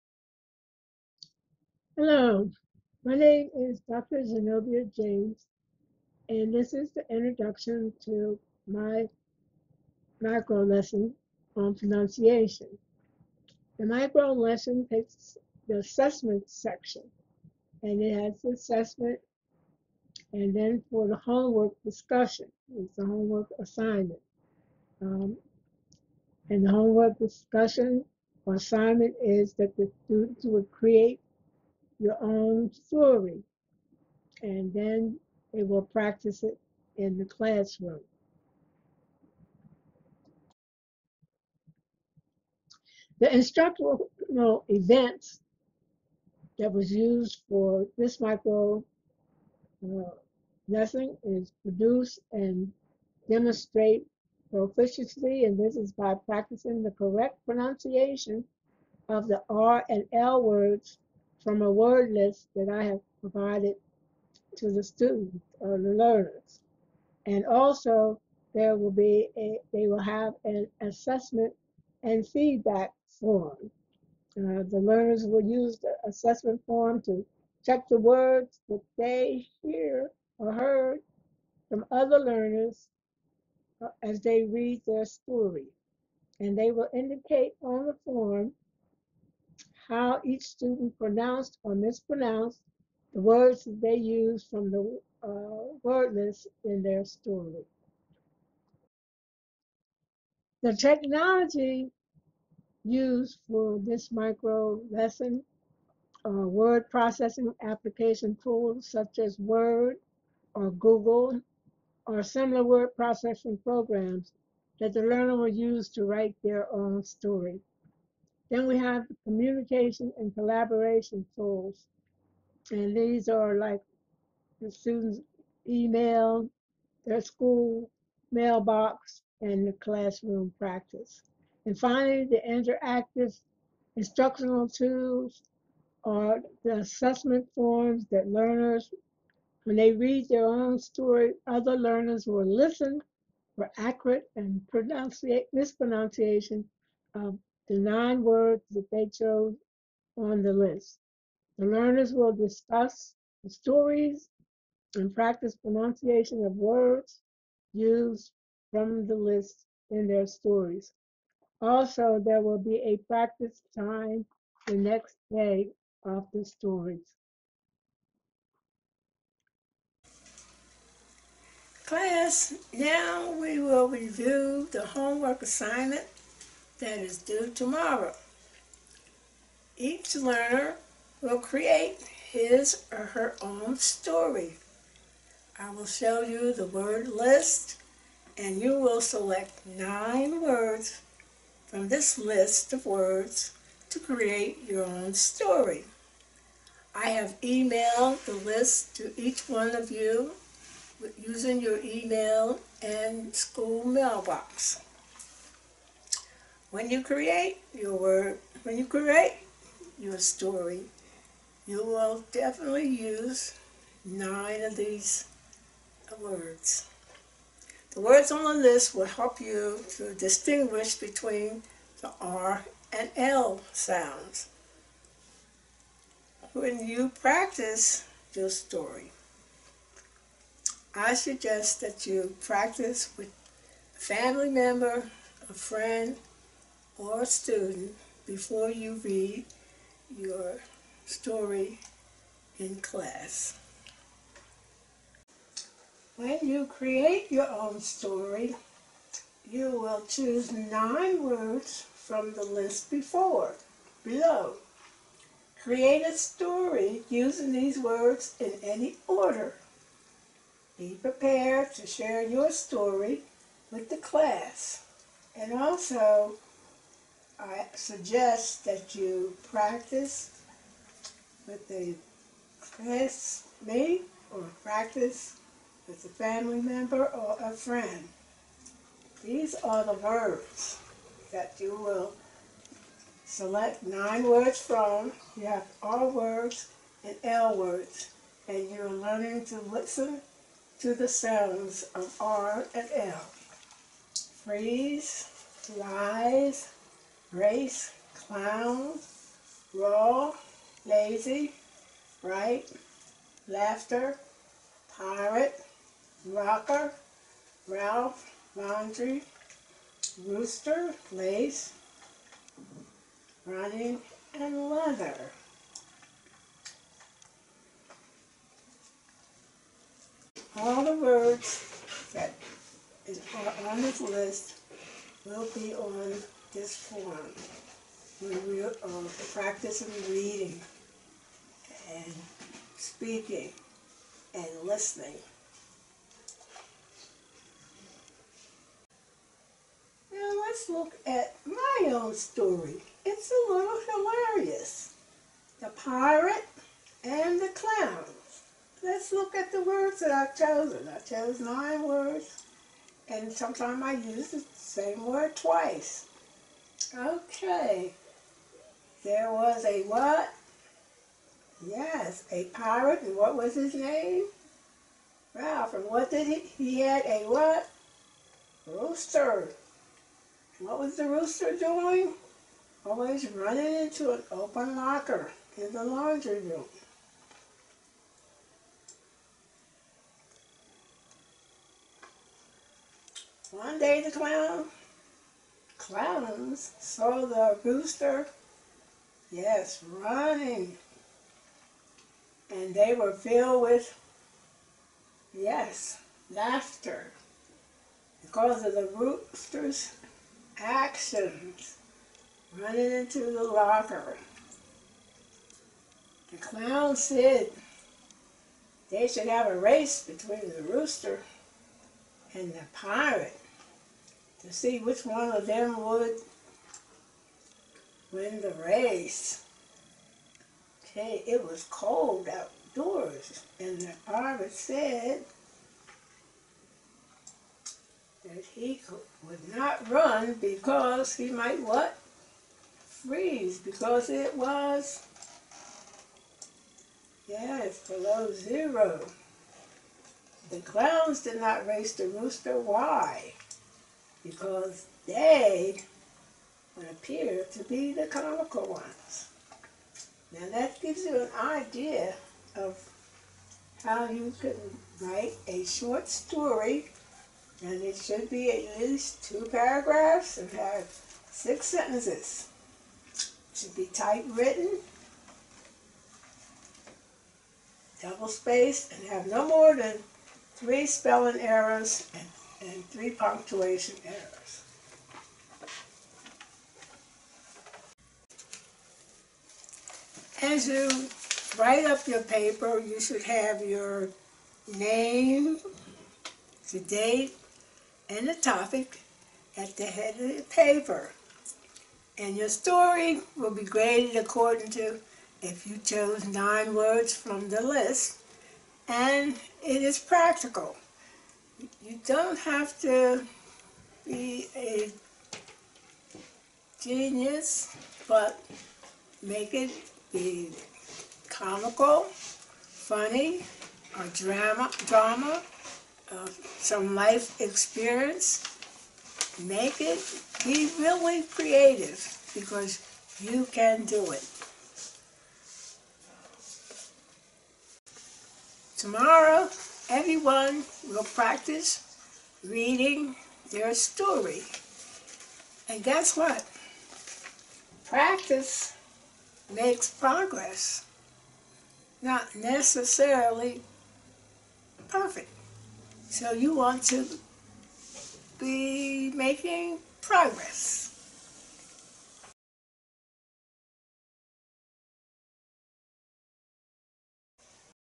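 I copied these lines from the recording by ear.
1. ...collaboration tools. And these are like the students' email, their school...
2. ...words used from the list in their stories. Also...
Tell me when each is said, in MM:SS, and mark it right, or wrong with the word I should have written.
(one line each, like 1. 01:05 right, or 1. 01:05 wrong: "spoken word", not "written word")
1. 02:00 right
2. 02:36 right.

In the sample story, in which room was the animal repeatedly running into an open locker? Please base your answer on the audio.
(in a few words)
The laundry room.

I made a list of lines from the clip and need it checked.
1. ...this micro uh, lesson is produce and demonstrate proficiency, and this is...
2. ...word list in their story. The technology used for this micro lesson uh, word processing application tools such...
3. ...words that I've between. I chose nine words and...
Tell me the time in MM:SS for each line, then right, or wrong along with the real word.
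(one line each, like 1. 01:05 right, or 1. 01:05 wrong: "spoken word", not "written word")
1. 00:47 right
2. 01:35 right
3. 05:49 wrong: "chosen", not "between".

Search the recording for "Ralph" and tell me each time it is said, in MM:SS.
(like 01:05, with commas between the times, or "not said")
05:07, 06:05.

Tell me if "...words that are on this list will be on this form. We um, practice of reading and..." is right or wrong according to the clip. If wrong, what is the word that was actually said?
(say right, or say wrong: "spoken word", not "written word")
right.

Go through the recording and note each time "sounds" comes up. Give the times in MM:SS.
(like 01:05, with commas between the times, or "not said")
03:43, 04:51.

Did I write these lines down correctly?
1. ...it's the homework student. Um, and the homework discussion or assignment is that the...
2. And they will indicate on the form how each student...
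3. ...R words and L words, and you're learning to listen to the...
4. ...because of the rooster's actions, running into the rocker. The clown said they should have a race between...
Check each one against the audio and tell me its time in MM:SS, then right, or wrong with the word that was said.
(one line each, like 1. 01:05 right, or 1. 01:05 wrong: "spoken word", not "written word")
1. 00:22 wrong: "assignment", not "student"
2. 01:26 right
3. 04:45 right
4. 06:38 wrong: "locker", not "rocker".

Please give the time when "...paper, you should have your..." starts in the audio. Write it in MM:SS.
08:02.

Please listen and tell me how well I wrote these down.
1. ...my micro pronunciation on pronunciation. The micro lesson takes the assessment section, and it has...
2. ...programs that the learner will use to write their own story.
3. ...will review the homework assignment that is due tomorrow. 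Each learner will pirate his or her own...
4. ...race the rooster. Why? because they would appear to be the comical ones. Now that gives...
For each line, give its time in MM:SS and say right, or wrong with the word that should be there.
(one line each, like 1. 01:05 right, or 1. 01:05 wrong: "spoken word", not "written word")
1. 00:08 wrong: "lesson", not "pronunciation"
2. 01:53 right
3. 02:53 wrong: "create", not "pirate"
4. 07:21 wrong: "conical", not "comical".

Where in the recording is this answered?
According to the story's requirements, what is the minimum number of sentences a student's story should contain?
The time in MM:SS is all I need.
07:41.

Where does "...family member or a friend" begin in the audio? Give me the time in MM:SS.
04:36.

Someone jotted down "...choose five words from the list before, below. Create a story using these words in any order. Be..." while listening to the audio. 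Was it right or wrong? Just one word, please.
wrong.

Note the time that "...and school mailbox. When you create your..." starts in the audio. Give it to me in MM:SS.
03:22.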